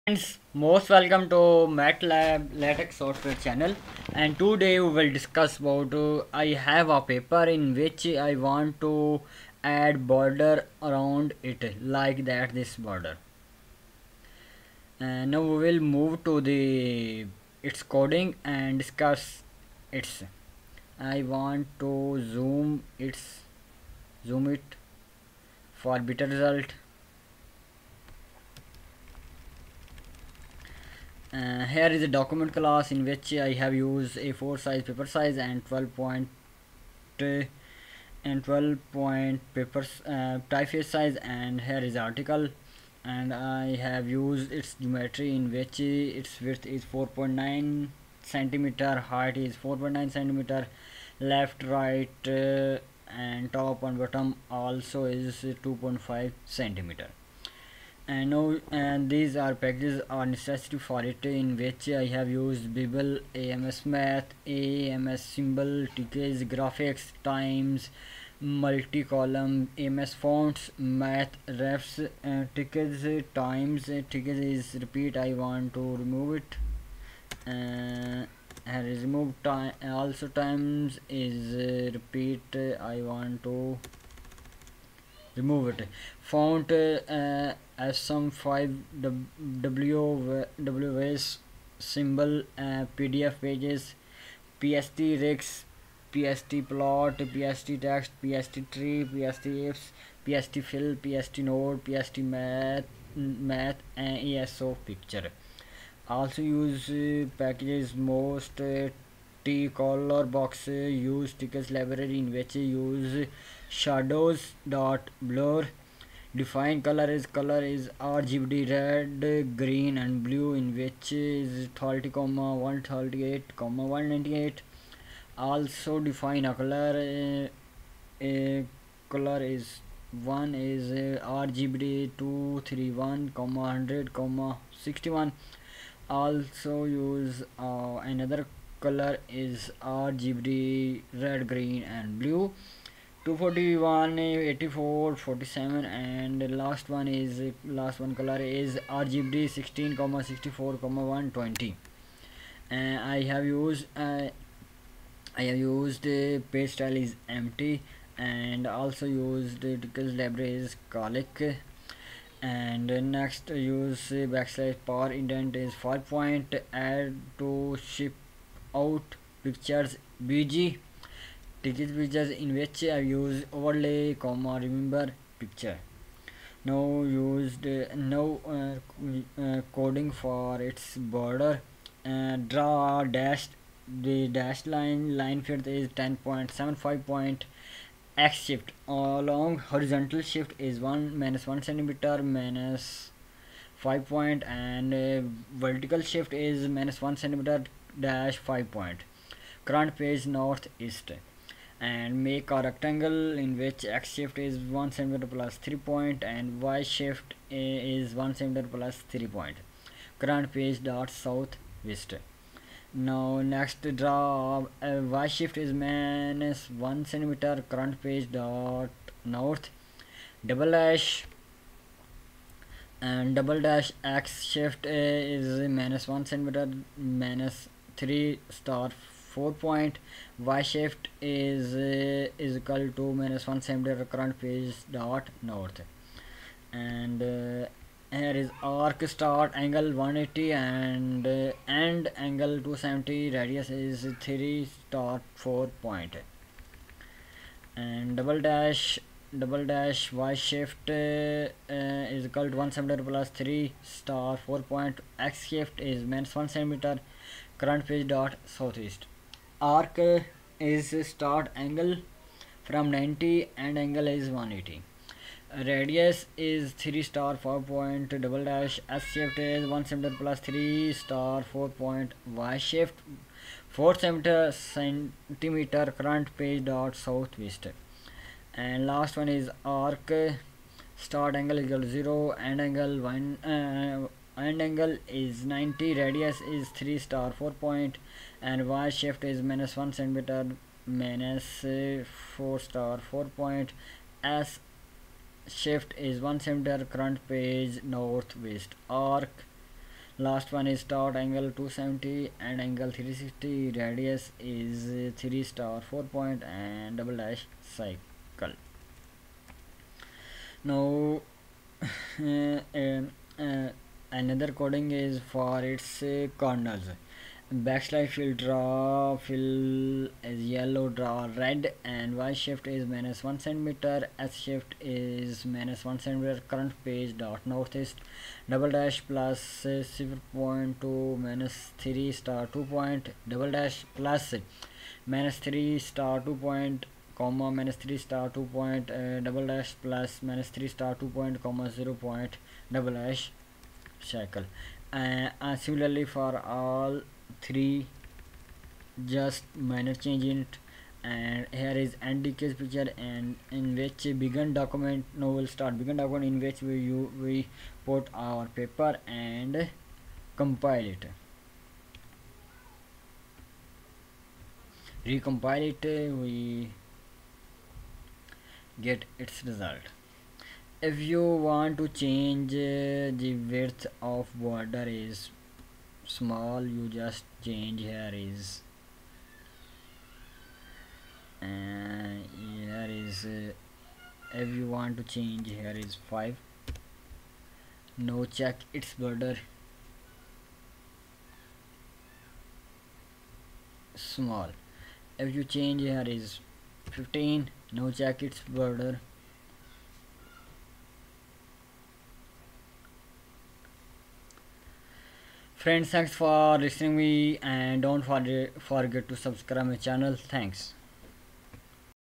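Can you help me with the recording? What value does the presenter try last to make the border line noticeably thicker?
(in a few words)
15.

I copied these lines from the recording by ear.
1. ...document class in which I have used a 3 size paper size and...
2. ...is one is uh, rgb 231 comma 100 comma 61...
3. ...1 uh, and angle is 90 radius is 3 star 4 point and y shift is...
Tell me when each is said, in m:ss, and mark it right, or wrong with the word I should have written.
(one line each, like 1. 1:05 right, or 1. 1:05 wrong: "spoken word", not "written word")
1. 0:32 wrong: "4", not "3"
2. 2:09 right
3. 4:43 right.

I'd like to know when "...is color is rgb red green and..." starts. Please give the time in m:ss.
1:57.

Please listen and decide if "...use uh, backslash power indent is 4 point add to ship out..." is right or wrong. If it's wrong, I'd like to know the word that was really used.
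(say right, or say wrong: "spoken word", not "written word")
wrong: "5", not "4".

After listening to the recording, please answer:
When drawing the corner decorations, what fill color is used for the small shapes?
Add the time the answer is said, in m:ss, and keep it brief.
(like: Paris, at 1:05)
yellow, at 5:20.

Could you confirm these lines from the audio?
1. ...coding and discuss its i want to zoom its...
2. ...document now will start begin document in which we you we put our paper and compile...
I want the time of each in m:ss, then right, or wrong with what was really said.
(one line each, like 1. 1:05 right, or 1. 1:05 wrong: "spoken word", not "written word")
1. 0:17 right
2. 5:54 right.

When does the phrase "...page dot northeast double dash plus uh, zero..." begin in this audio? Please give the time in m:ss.
5:26.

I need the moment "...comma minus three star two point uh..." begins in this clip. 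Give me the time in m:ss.
5:37.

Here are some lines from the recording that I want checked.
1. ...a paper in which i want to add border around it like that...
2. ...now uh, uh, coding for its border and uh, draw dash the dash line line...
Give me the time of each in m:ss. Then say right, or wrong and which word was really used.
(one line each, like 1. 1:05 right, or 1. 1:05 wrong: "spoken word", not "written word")
1. 0:06 right
2. 2:57 right.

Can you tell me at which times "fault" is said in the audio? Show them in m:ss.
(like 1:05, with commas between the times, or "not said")
not said.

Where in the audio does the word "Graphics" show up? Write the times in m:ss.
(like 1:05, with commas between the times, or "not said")
1:06.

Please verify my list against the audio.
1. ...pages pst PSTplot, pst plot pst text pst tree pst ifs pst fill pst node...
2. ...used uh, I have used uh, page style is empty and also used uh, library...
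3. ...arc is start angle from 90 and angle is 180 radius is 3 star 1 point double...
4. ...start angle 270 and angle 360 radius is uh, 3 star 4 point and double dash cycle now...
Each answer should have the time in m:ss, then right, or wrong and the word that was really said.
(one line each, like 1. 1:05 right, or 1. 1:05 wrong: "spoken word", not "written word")
1. 1:33 right
2. 2:33 right
3. 4:19 wrong: "4", not "1"
4. 5:00 right.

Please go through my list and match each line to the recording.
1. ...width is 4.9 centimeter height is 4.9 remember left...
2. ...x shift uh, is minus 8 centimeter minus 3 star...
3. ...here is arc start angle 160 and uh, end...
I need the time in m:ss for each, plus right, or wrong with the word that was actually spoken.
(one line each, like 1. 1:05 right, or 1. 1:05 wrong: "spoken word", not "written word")
1. 0:46 wrong: "centimeter", not "remember"
2. 3:44 wrong: "1", not "8"
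3. 3:58 wrong: "180", not "160".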